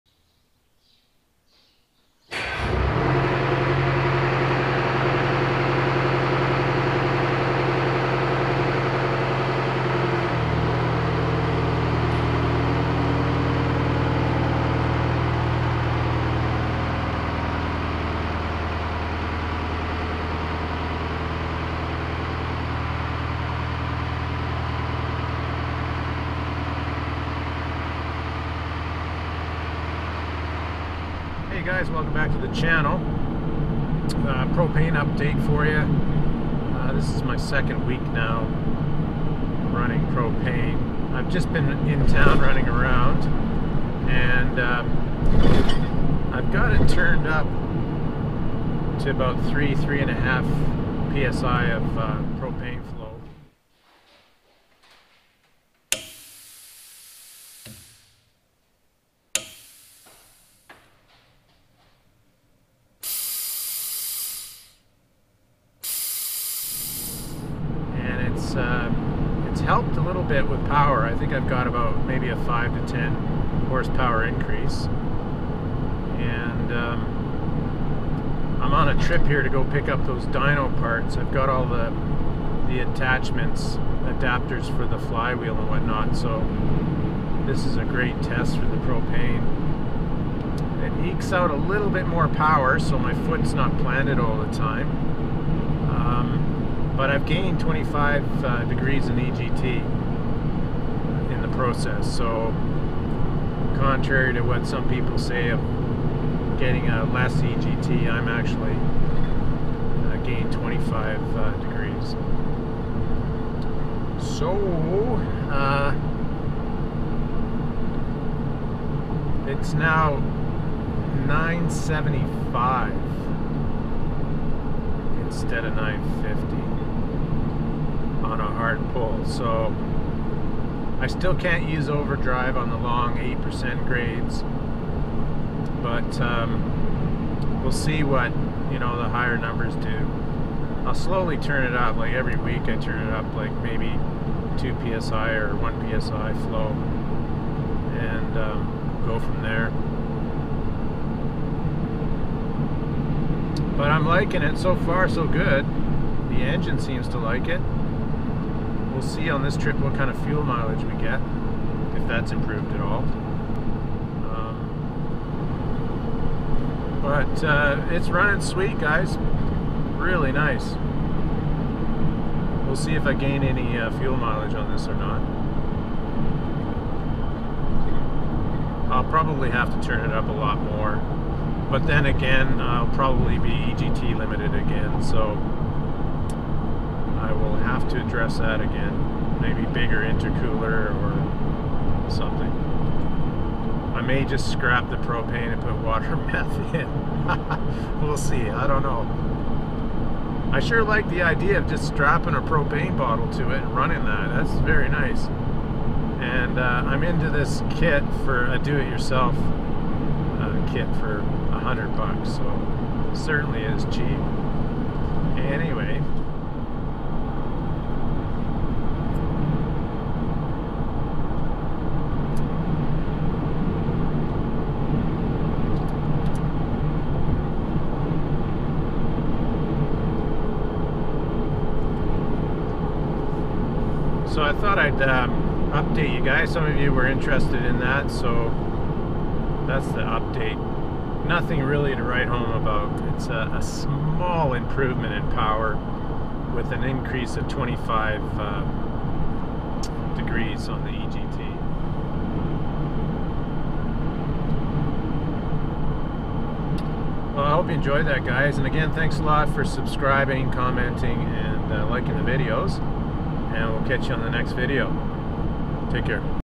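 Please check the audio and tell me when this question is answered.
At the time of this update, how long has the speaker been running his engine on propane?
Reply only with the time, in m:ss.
0:37.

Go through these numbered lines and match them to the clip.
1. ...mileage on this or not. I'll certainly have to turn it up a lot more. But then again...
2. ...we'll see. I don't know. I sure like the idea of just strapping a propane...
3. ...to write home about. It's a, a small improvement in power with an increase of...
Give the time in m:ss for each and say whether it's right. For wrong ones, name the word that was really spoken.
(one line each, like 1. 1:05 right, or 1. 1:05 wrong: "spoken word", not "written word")
1. 2:54 wrong: "probably", not "certainly"
2. 3:18 right
3. 4:01 right.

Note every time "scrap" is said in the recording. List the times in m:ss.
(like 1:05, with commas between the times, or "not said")
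3:14.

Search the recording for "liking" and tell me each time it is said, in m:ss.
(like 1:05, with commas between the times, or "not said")
2:34, 4:21.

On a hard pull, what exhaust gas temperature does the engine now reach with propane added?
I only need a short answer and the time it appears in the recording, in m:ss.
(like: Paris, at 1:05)
975, at 2:01.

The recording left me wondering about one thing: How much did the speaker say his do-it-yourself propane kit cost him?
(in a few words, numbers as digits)
100 bucks.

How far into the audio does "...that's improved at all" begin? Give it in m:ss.
2:42.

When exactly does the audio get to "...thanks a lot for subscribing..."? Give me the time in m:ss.
4:18.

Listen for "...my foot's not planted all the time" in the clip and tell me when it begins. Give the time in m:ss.
1:32.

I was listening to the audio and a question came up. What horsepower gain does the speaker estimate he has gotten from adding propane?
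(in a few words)
5 to 10 horsepower.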